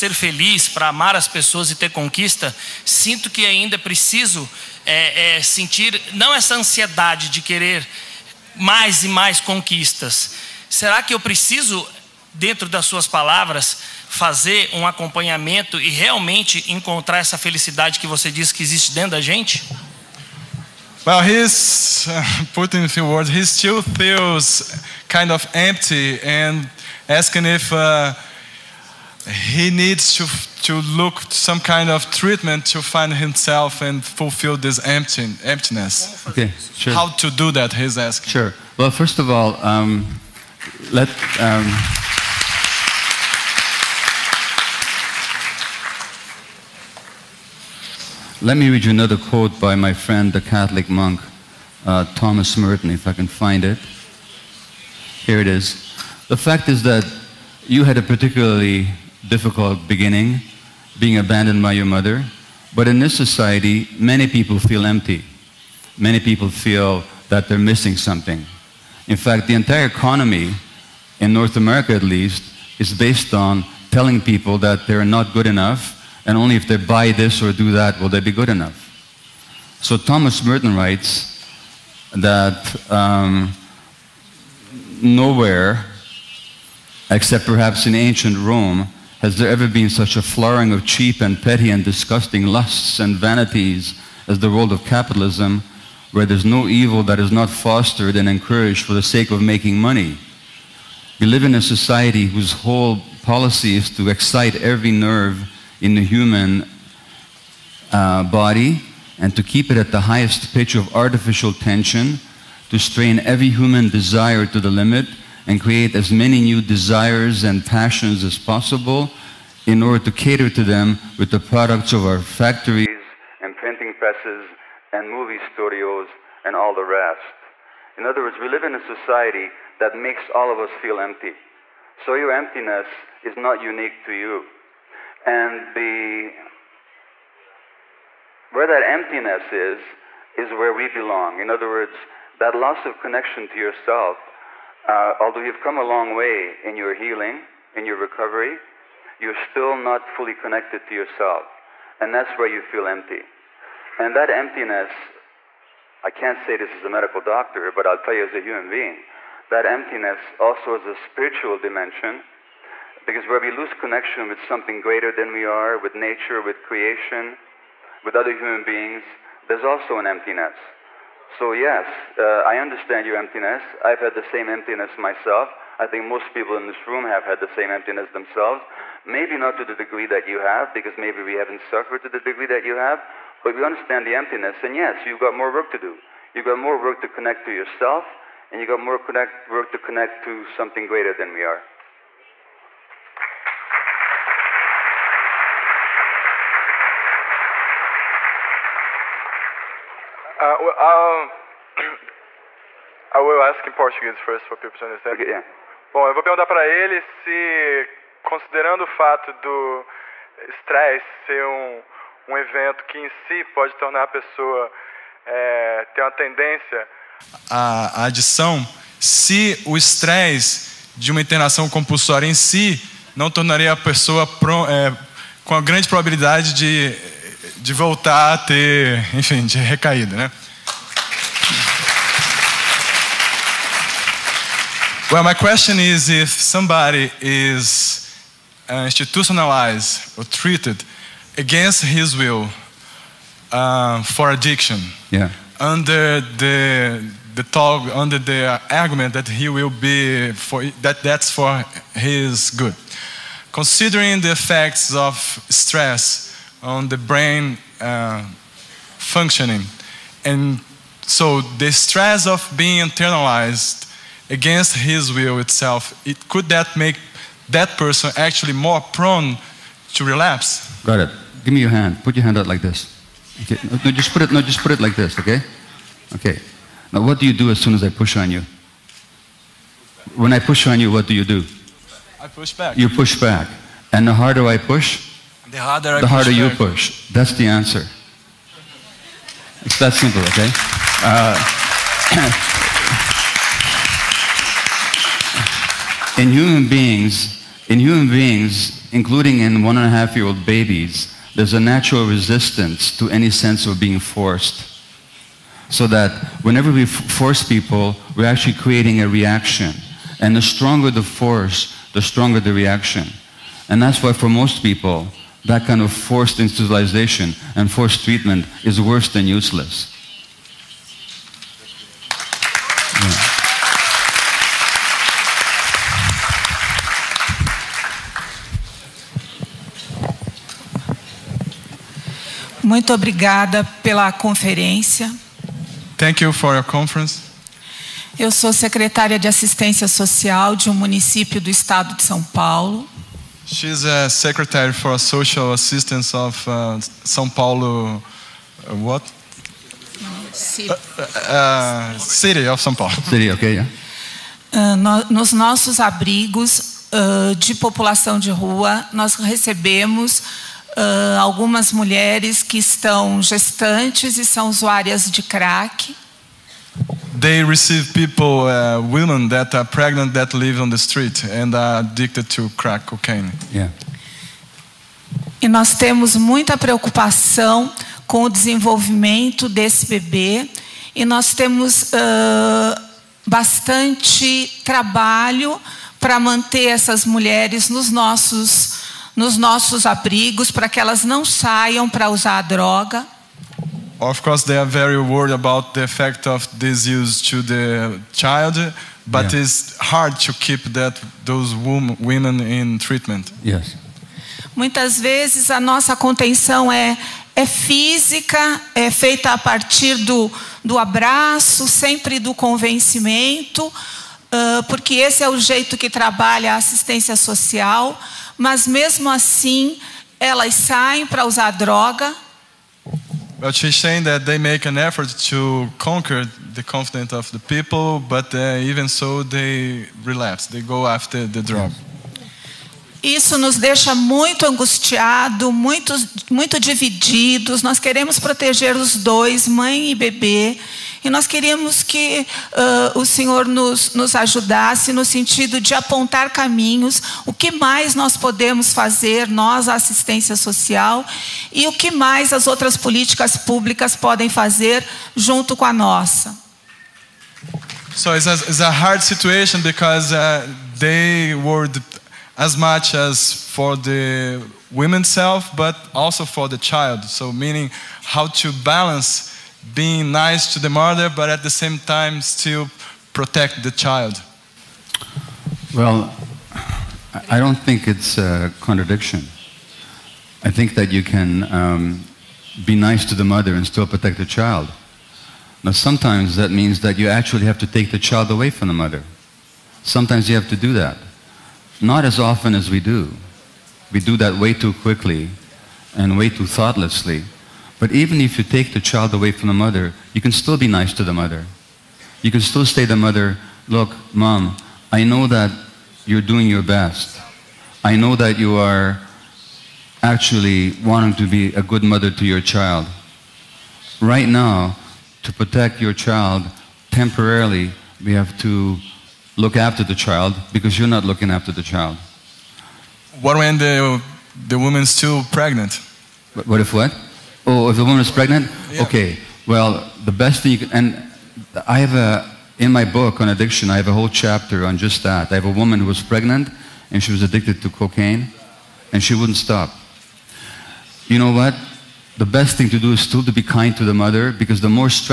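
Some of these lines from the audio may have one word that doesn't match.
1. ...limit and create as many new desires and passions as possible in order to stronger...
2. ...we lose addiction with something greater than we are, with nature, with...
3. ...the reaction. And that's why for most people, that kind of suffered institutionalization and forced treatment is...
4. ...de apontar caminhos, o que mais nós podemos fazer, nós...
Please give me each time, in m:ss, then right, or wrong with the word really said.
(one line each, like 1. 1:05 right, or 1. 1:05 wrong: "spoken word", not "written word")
1. 1:54 wrong: "cater", not "stronger"
2. 2:43 wrong: "connection", not "addiction"
3. 5:12 wrong: "forced", not "suffered"
4. 7:25 right.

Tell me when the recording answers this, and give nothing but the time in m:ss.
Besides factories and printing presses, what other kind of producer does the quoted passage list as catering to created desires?
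2:05.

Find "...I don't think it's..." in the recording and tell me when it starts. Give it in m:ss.
7:57.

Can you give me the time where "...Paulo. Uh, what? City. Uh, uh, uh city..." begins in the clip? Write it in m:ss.
5:47.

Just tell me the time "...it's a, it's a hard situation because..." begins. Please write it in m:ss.
7:38.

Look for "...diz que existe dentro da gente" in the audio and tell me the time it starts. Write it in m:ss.
0:18.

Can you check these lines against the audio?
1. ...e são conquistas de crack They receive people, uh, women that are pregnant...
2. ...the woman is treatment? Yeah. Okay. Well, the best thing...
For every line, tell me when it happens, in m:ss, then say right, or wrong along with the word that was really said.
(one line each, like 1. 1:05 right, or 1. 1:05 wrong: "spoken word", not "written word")
1. 6:04 wrong: "usuárias", not "conquistas"
2. 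8:47 wrong: "pregnant", not "treatment".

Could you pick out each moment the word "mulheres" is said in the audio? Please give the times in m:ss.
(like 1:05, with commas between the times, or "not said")
6:01, 6:27.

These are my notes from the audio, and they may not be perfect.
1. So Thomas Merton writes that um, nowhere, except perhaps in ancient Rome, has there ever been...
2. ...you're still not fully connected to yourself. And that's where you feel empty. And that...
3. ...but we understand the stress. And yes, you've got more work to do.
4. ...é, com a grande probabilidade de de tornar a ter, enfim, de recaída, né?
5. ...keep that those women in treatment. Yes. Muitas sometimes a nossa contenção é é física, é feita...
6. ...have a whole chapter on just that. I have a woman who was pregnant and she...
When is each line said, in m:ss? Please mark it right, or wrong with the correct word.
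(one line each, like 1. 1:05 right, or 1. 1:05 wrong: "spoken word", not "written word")
1. 1:19 right
2. 2:29 right
3. 3:03 wrong: "emptiness", not "stress"
4. 3:44 wrong: "voltar", not "tornar"
5. 6:40 wrong: "vezes", not "sometimes"
6. 8:53 right.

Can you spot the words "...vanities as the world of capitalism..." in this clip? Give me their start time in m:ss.
1:33.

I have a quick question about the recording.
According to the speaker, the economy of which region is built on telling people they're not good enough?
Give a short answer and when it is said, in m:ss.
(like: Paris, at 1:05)
North America, at 1:11.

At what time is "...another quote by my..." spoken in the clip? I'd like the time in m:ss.
0:48.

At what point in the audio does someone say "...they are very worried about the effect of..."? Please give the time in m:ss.
6:34.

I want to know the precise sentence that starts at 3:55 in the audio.
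Well, my question is if somebody is uh, institutionalized or treated against his will uh, for addiction, yeah.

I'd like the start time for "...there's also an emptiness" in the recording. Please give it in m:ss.
2:49.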